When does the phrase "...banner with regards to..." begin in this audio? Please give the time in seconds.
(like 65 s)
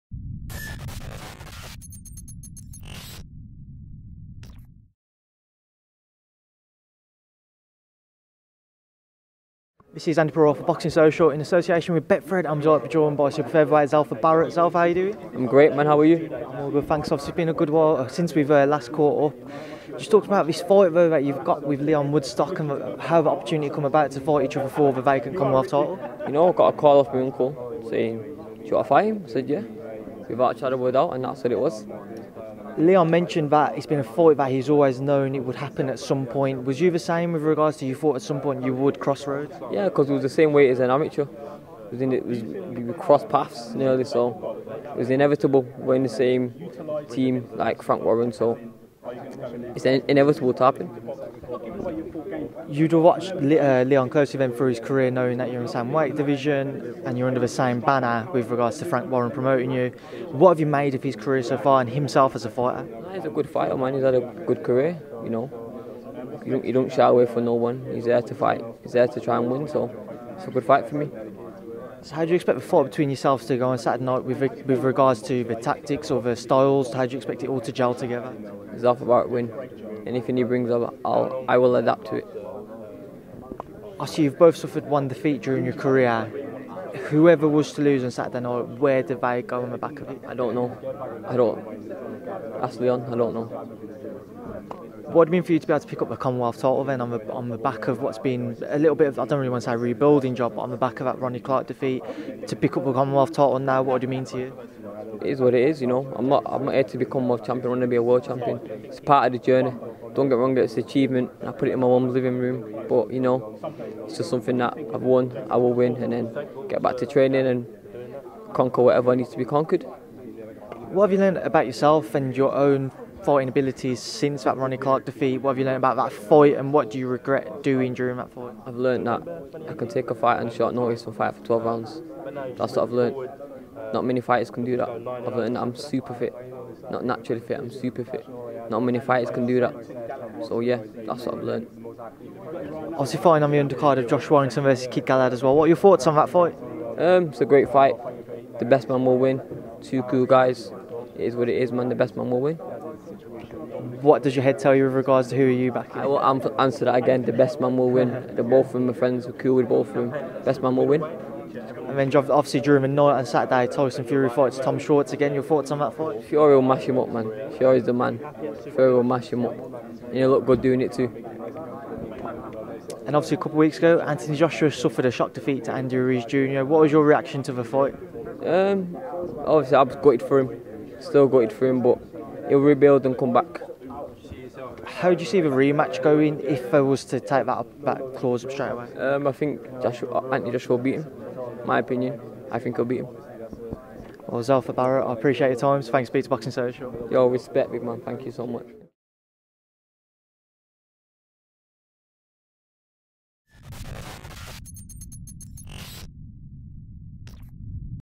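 57 s.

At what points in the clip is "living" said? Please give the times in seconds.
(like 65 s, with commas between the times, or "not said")
112 s.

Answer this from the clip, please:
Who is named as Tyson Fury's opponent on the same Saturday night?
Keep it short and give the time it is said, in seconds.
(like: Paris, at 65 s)
Tom Schwarz, at 164 s.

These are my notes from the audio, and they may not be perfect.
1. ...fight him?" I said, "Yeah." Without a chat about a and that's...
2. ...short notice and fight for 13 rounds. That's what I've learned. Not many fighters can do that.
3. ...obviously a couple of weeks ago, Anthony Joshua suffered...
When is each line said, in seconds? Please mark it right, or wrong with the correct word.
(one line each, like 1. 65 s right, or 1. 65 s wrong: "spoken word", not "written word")
1. 28 s right
2. 130 s wrong: "12", not "13"
3. 173 s right.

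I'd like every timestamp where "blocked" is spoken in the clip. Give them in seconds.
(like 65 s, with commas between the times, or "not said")
not said.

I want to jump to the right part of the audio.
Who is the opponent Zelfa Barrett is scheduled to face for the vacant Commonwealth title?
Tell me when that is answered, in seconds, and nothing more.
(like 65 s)
21 s.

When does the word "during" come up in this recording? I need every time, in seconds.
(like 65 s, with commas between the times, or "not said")
85 s, 127 s, 162 s.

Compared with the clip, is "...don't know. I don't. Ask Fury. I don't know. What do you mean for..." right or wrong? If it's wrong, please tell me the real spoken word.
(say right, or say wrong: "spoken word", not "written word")
wrong: "Leon", not "Fury".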